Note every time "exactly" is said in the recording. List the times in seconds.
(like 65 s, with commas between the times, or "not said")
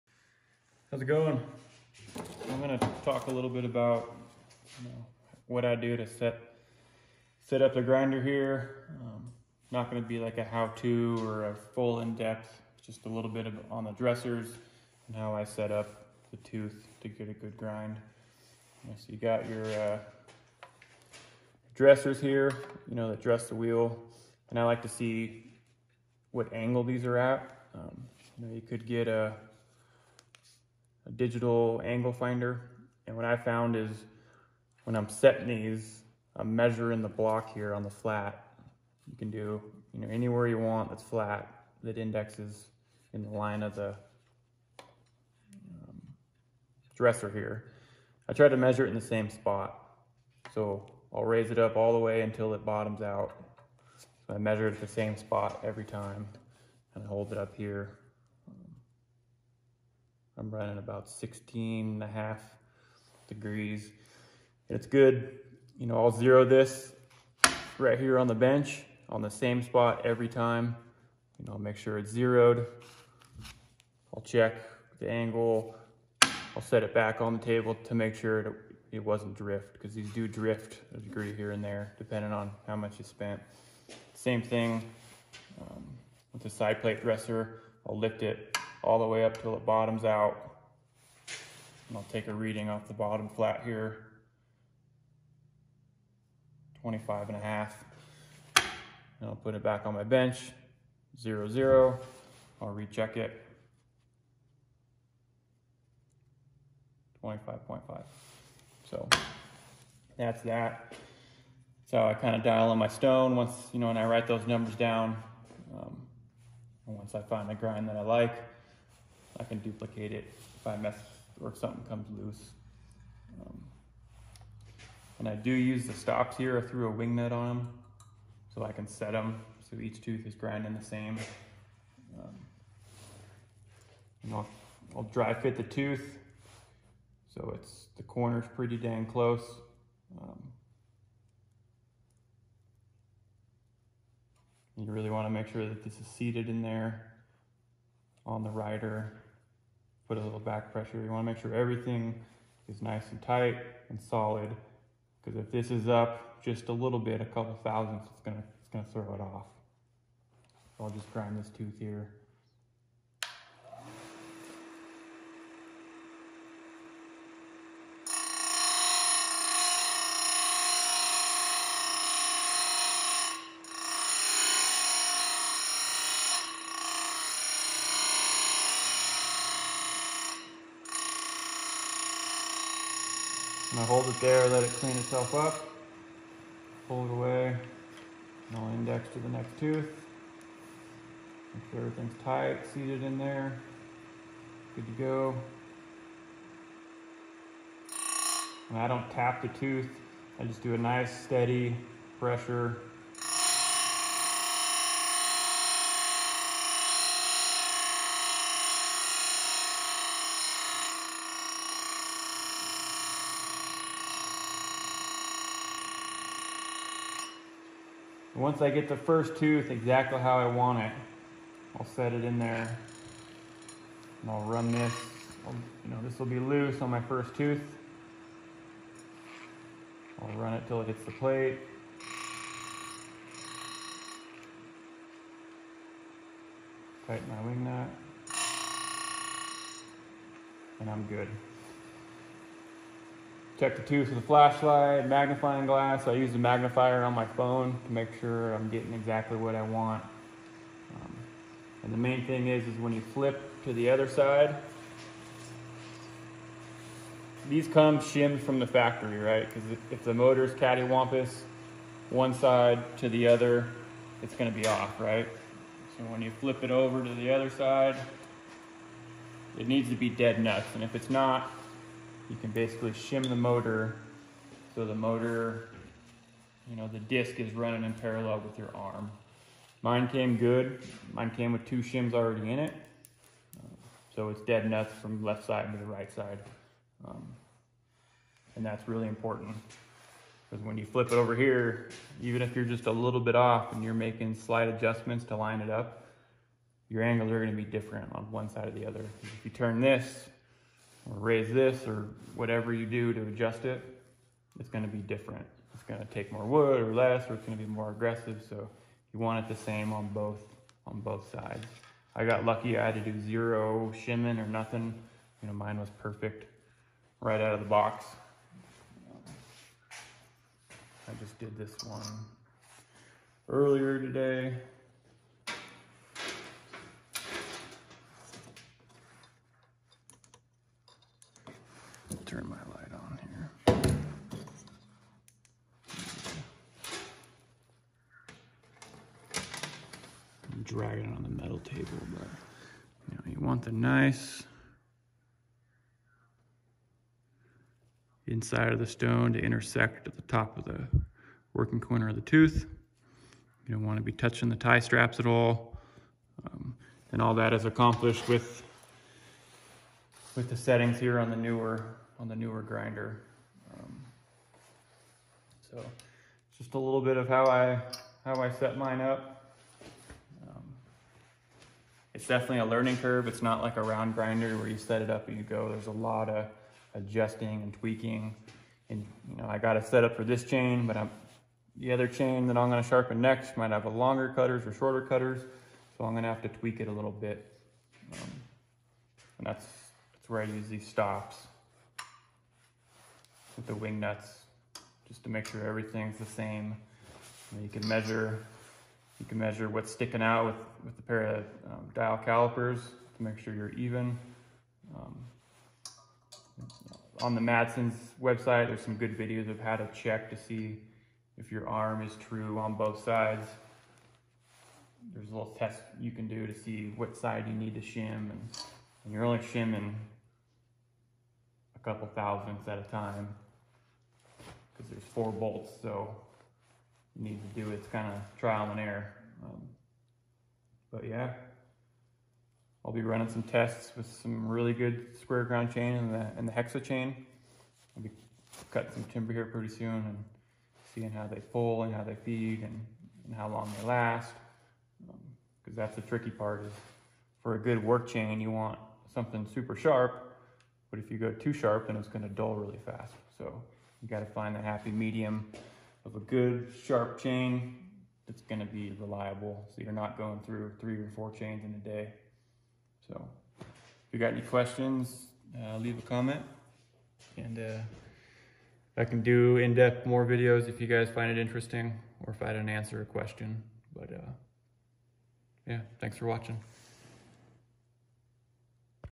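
219 s, 248 s.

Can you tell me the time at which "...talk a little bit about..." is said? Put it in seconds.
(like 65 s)
3 s.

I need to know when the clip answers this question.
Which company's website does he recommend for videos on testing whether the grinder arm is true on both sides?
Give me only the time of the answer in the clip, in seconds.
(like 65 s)
407 s.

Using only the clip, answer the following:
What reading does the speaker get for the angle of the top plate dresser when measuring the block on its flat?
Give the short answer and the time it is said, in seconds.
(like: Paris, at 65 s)
16.5 degrees, at 61 s.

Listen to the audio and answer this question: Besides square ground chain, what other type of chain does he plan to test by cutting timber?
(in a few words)
hexa chain.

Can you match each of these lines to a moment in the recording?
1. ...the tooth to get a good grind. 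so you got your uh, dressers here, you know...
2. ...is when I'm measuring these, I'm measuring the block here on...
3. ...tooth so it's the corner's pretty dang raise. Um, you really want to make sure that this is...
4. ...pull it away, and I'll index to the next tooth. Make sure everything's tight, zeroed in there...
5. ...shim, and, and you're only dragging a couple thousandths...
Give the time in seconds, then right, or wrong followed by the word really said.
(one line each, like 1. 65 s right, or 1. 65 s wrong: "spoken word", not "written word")
1. 16 s right
2. 33 s wrong: "setting", not "measuring"
3. 135 s wrong: "close", not "raise"
4. 186 s wrong: "seated", not "zeroed"
5. 417 s wrong: "shimming", not "dragging".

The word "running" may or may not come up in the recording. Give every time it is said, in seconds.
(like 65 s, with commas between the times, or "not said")
60 s, 277 s, 433 s.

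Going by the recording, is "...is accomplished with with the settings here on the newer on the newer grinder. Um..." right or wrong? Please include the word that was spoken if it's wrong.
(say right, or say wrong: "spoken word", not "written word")
right.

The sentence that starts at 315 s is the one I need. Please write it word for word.
You know, mine was perfect right out of the box.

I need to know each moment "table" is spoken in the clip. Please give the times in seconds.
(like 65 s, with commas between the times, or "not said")
77 s, 341 s.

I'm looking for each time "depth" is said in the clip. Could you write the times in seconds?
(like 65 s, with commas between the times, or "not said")
12 s, 469 s.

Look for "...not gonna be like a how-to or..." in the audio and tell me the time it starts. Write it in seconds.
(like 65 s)
9 s.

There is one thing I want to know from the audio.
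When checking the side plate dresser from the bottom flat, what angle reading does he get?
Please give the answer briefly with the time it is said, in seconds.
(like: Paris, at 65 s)
25.5, at 96 s.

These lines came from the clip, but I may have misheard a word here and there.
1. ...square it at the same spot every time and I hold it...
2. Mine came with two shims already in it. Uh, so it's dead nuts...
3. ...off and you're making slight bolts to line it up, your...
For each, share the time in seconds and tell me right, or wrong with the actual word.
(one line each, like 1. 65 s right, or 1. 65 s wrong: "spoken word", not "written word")
1. 54 s wrong: "measure", not "square"
2. 281 s right
3. 293 s wrong: "adjustments", not "bolts".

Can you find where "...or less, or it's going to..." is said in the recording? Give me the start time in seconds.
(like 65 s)
306 s.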